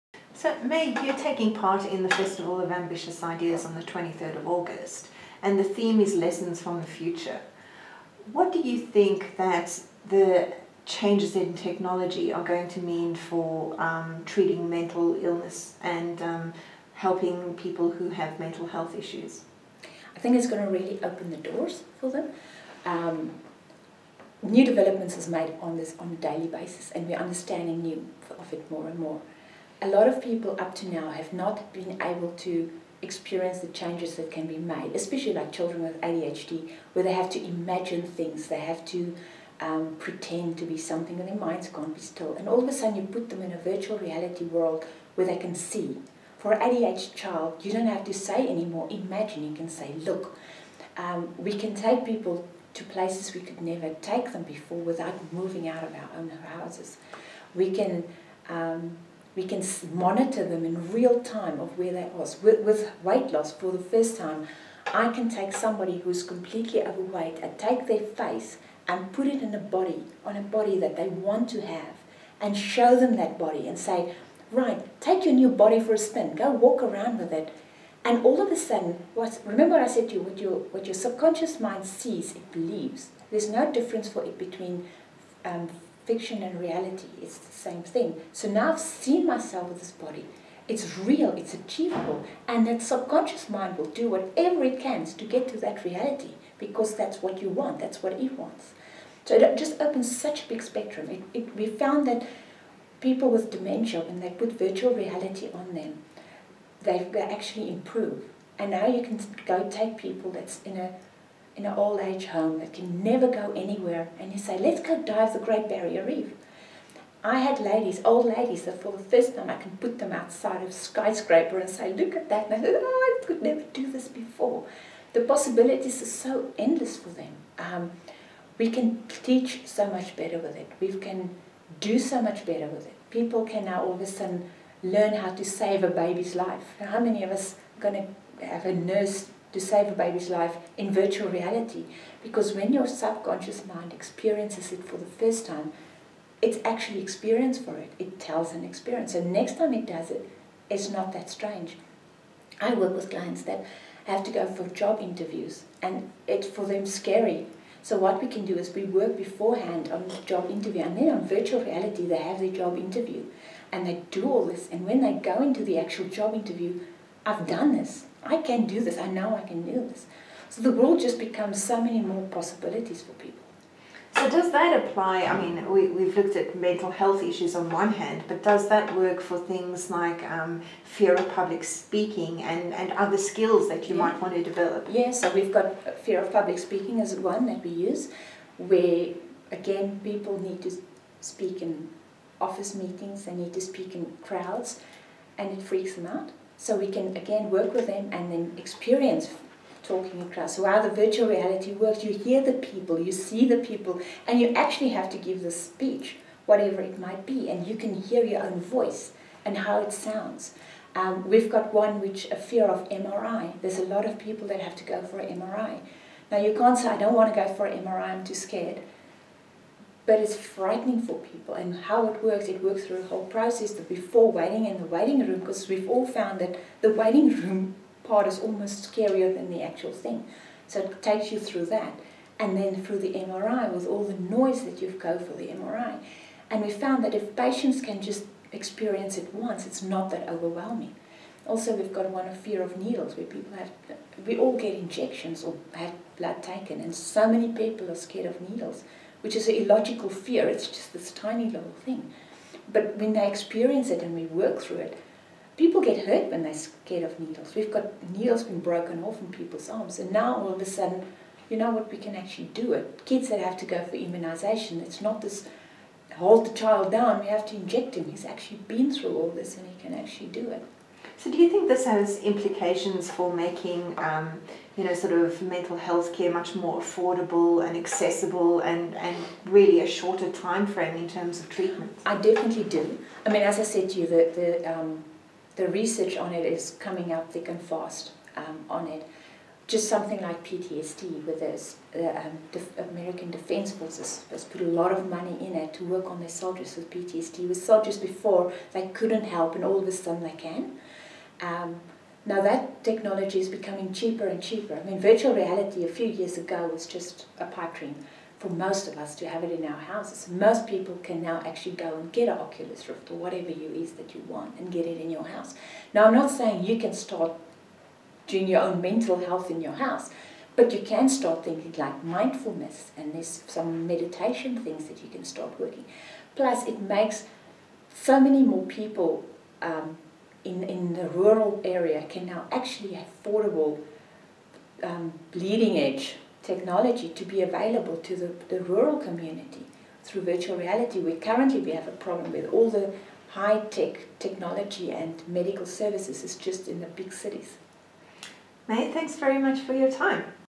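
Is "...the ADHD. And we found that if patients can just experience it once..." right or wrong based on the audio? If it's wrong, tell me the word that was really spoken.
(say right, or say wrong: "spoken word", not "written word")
wrong: "MRI", not "ADHD".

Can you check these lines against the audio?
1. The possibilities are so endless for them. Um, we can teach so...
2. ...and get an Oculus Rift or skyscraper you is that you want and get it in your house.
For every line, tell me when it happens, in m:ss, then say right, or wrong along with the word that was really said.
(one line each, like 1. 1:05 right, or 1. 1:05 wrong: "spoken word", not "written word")
1. 2:05 right
2. 5:11 wrong: "whatever", not "skyscraper".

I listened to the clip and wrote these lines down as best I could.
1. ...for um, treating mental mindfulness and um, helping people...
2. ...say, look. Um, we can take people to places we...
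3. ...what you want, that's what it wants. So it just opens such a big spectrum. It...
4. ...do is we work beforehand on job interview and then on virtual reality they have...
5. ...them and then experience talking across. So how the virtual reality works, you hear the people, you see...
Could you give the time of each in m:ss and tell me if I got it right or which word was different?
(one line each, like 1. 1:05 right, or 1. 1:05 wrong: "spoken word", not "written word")
1. 0:13 wrong: "illness", not "mindfulness"
2. 0:49 right
3. 1:37 right
4. 2:38 right
5. 3:17 right.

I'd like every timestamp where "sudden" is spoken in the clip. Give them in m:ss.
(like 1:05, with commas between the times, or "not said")
0:42, 1:18, 2:14, 4:20, 4:59.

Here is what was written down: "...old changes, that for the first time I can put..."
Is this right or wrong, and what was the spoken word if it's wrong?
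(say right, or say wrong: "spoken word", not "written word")
wrong: "ladies", not "changes".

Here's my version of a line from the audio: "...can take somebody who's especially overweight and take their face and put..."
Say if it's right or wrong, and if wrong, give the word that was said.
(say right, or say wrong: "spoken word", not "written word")
wrong: "completely", not "especially".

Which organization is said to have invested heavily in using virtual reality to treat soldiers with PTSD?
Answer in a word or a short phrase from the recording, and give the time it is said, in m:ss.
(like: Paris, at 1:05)
American Defense Forces, at 4:52.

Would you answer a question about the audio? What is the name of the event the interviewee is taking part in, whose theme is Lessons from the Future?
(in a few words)
Festival of Ambitious Ideas.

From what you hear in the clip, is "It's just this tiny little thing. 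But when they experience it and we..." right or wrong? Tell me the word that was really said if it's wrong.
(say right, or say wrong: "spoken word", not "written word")
right.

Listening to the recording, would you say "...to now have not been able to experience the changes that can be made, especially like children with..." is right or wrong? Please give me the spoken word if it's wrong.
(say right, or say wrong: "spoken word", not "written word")
right.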